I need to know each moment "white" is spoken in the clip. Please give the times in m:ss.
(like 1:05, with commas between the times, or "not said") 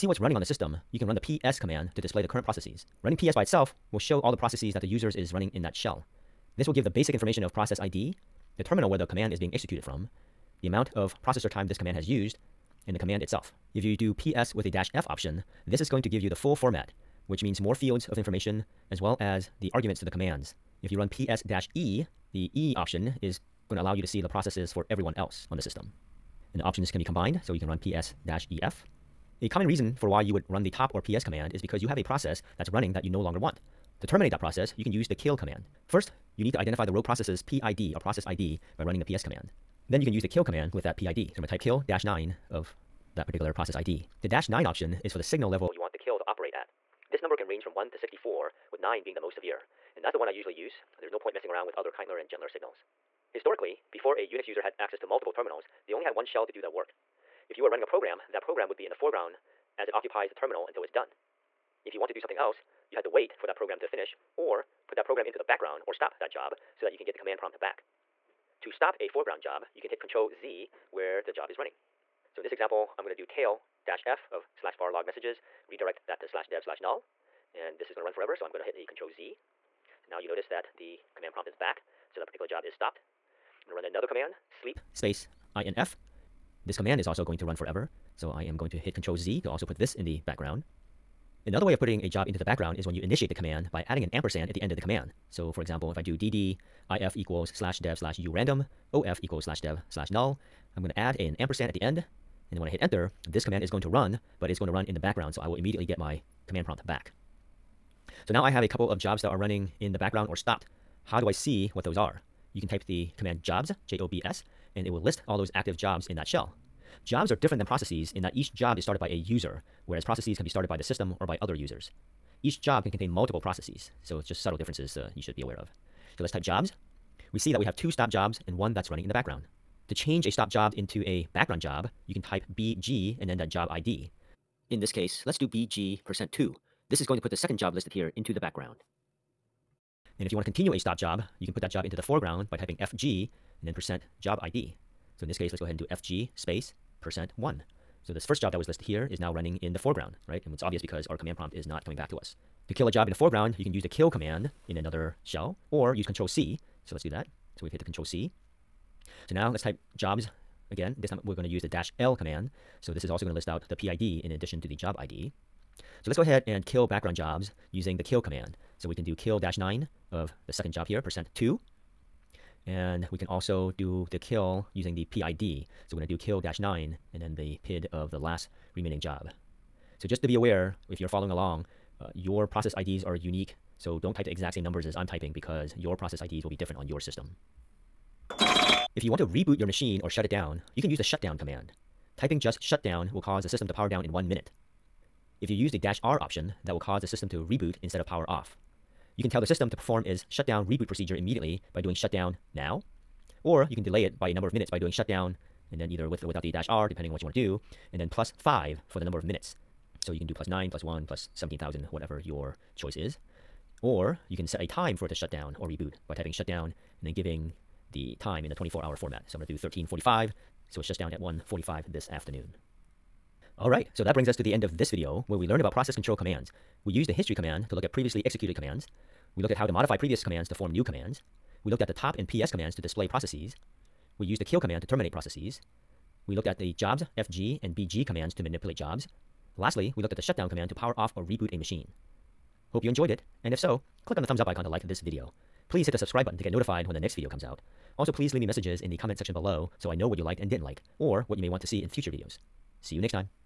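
not said.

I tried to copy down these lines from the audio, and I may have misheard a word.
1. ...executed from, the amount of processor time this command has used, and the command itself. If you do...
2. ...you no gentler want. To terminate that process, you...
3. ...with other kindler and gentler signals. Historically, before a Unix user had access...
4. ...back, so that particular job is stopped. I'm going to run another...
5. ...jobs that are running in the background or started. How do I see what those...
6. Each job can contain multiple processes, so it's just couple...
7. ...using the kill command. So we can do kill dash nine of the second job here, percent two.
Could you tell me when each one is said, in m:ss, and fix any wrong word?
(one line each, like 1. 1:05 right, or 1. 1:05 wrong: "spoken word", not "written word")
1. 0:09 right
2. 0:33 wrong: "longer", not "gentler"
3. 0:51 right
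4. 1:21 right
5. 1:48 wrong: "stopped", not "started"
6. 2:02 wrong: "subtle", not "couple"
7. 2:47 right.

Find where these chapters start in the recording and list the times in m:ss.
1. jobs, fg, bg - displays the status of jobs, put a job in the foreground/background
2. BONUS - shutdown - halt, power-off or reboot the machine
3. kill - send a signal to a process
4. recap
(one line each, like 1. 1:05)
1. 0:53
2. 3:06
3. 0:32
4. 3:43.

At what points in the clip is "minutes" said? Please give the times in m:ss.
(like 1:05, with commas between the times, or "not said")
3:14, 3:24, 3:29.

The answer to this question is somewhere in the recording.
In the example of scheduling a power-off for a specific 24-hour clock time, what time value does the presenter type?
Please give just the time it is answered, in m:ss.
3:39.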